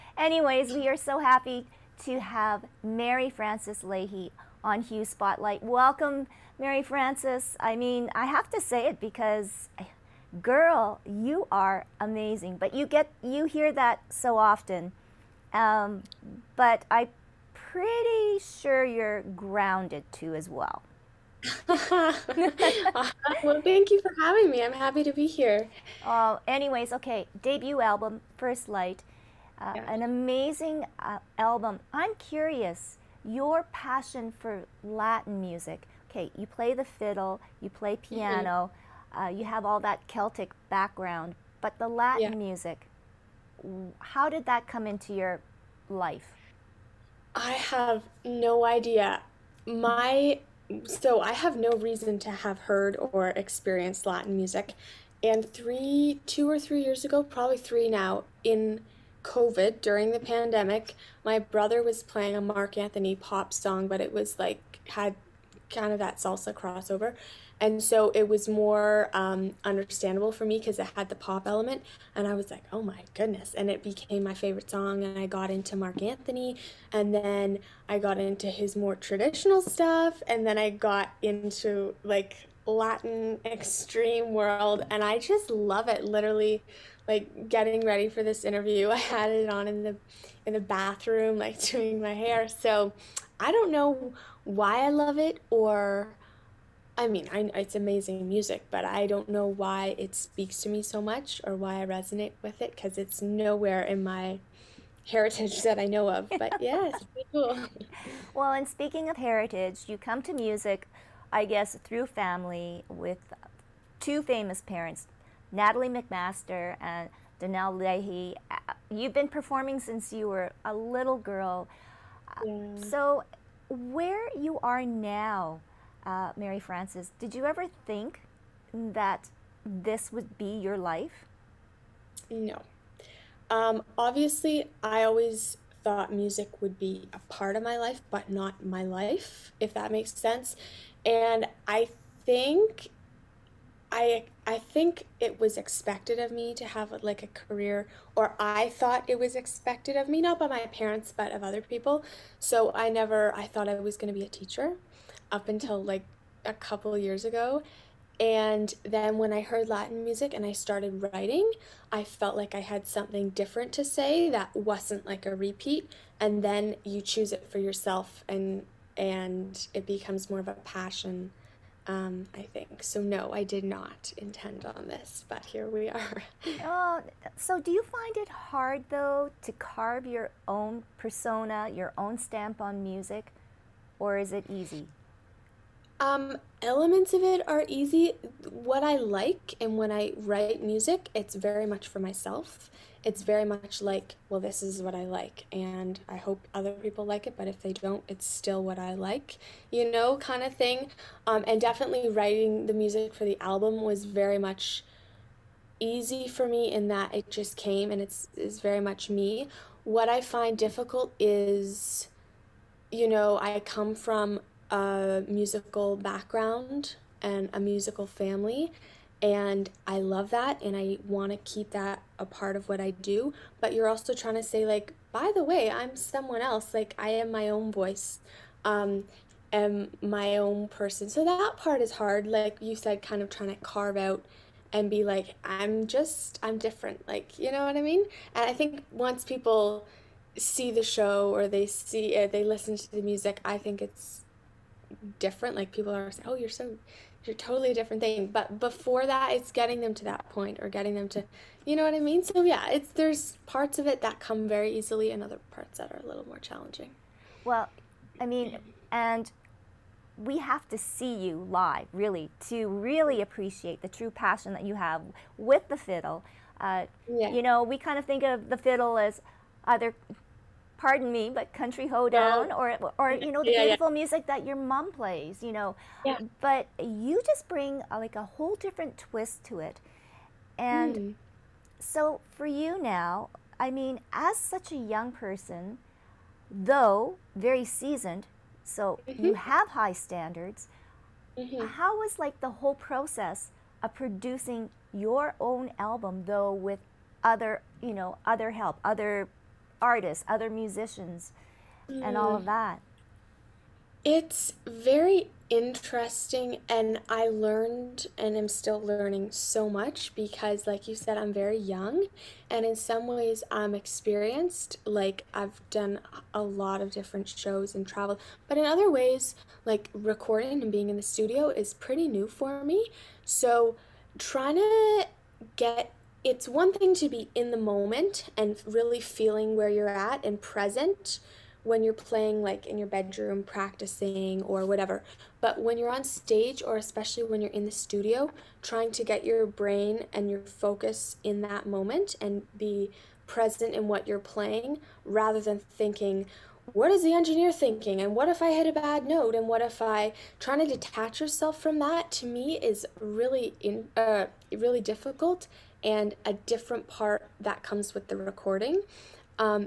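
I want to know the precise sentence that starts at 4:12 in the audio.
So yeah, it's there's parts of it that come very easily and other parts that are a little more challenging.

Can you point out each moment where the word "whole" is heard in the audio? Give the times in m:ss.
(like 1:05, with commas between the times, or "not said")
4:38, 4:52.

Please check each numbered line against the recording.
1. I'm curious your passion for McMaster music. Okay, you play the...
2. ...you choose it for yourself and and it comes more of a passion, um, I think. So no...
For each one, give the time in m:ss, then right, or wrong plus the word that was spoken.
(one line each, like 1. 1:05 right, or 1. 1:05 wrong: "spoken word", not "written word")
1. 0:31 wrong: "Latin", not "McMaster"
2. 2:46 wrong: "becomes", not "comes".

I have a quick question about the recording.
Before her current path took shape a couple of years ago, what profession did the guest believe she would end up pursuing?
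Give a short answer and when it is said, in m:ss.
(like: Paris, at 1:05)
Teacher, at 2:34.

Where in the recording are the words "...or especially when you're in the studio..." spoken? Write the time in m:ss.
5:36.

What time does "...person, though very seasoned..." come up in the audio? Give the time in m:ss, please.
4:45.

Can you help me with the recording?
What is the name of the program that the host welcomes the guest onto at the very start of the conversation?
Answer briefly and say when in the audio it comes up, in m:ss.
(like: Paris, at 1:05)
Hue Spotlight, at 0:04.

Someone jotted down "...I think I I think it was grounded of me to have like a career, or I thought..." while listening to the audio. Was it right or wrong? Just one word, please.
wrong.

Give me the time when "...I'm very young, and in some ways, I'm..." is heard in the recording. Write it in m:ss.
5:11.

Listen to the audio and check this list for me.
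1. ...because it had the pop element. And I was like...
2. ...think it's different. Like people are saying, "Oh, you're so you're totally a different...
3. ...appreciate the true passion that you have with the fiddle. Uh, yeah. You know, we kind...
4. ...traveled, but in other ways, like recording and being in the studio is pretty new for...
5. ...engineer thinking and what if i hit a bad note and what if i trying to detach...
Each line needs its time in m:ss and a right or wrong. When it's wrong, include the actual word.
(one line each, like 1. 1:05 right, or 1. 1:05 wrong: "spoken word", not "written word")
1. 1:10 right
2. 4:03 right
3. 4:23 right
4. 5:17 right
5. 5:47 right.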